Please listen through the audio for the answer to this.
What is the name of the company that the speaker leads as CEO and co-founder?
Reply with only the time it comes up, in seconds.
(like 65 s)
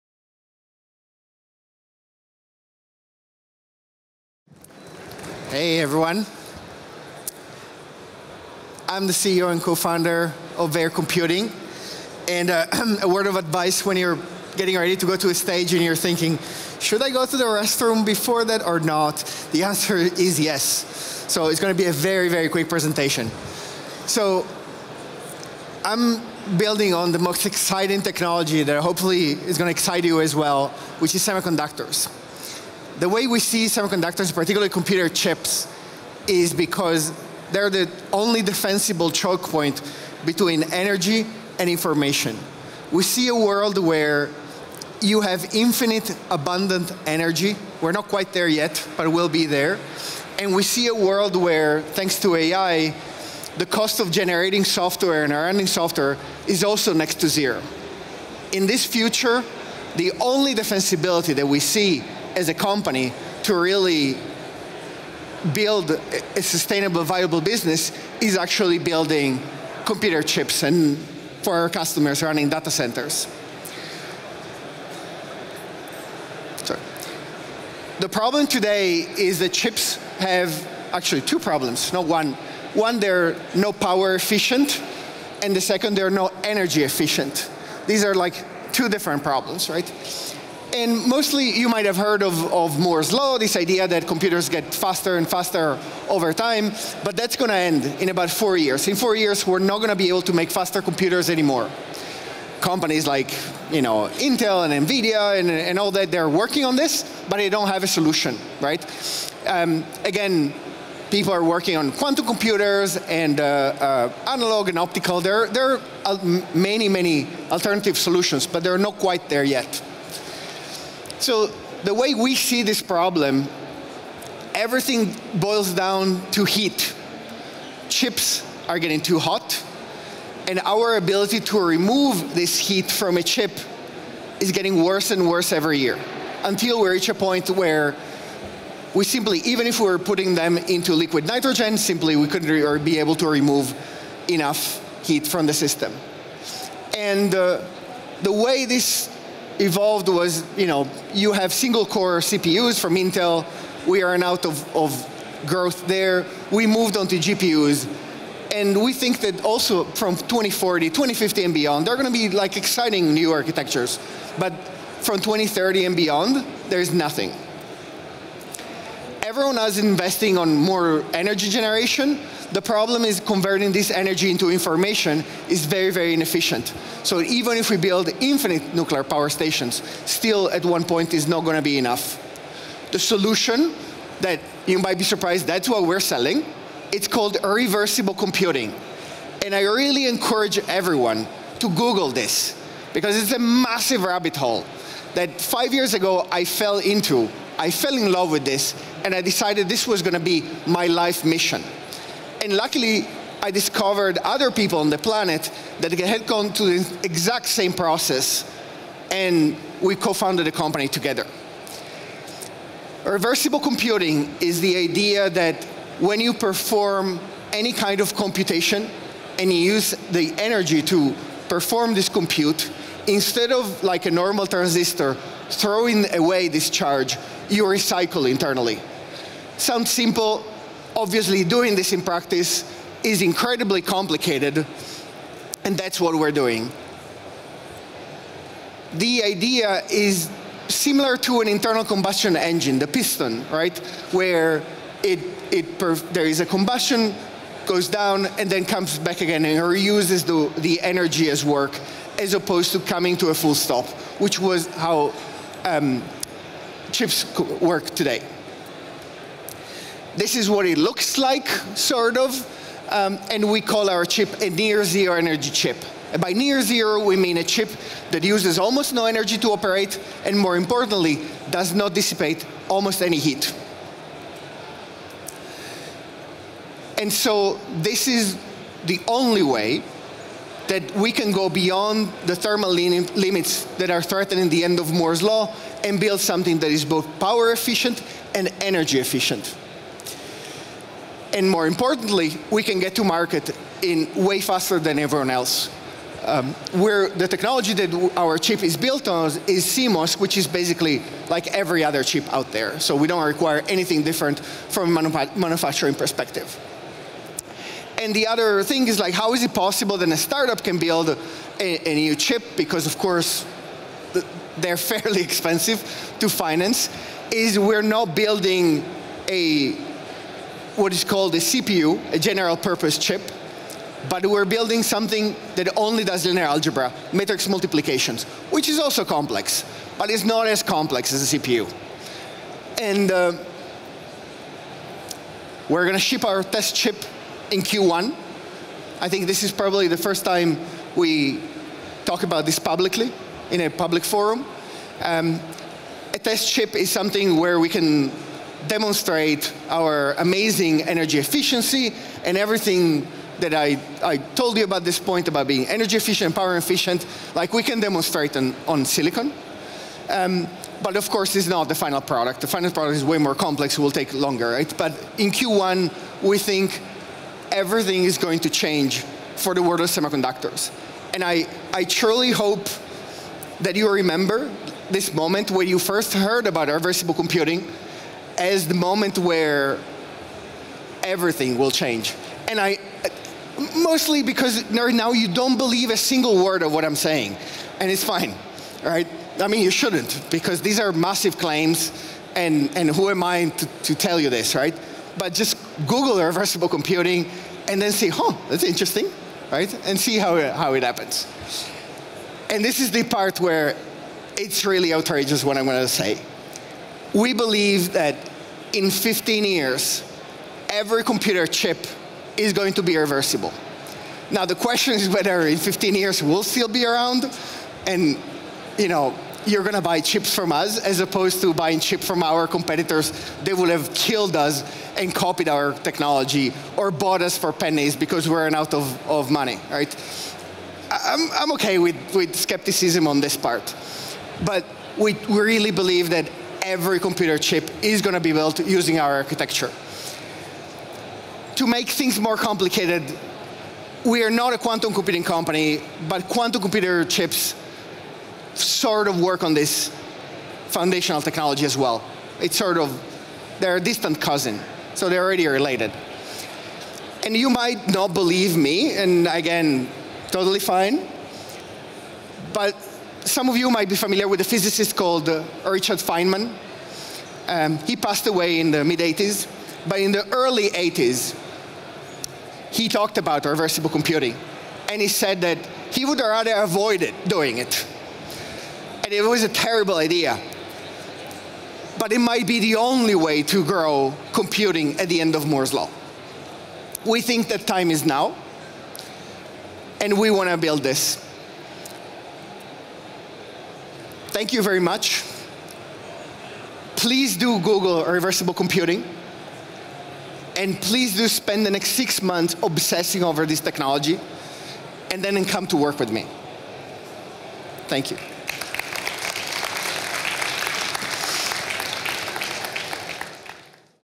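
10 s.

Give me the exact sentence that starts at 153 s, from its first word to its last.
We are out of, of growth there.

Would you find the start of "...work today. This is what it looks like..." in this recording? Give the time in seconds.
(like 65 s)
257 s.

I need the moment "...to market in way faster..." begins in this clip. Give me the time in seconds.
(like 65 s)
292 s.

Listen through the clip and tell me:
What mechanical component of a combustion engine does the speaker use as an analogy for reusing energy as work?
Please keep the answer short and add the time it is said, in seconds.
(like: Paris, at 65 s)
The piston, at 242 s.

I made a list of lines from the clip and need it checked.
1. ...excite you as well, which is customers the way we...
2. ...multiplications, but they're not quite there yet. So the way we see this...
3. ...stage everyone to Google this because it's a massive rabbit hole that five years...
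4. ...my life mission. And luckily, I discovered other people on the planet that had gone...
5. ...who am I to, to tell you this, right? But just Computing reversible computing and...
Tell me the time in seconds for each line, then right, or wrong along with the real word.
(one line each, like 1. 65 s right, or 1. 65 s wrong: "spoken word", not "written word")
1. 29 s wrong: "semiconductors", not "customers"
2. 117 s wrong: "solutions", not "multiplications"
3. 190 s wrong: "encourage", not "stage"
4. 200 s right
5. 392 s wrong: "Google", not "Computing".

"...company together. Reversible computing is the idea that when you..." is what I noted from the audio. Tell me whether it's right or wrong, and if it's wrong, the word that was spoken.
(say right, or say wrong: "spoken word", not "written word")
right.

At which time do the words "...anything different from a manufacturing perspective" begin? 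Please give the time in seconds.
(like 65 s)
303 s.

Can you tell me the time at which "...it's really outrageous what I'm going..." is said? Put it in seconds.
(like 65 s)
404 s.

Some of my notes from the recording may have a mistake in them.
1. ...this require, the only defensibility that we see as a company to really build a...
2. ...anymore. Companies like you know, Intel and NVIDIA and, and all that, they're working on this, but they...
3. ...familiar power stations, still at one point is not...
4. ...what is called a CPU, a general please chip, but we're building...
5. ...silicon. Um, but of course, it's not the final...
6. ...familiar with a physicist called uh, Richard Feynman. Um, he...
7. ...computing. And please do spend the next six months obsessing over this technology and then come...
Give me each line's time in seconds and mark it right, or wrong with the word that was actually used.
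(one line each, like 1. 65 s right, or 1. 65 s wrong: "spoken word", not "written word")
1. 58 s wrong: "future", not "require"
2. 101 s right
3. 178 s wrong: "nuclear", not "familiar"
4. 320 s wrong: "purpose", not "please"
5. 358 s right
6. 463 s right
7. 498 s right.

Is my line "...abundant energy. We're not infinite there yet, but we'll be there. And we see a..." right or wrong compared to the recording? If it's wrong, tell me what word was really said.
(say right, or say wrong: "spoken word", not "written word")
wrong: "quite", not "infinite".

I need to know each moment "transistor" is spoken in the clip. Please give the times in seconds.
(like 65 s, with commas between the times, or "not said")
224 s.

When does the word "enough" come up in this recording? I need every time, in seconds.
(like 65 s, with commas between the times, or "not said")
144 s, 181 s.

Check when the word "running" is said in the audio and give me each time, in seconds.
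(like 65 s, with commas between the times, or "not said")
55 s, 72 s.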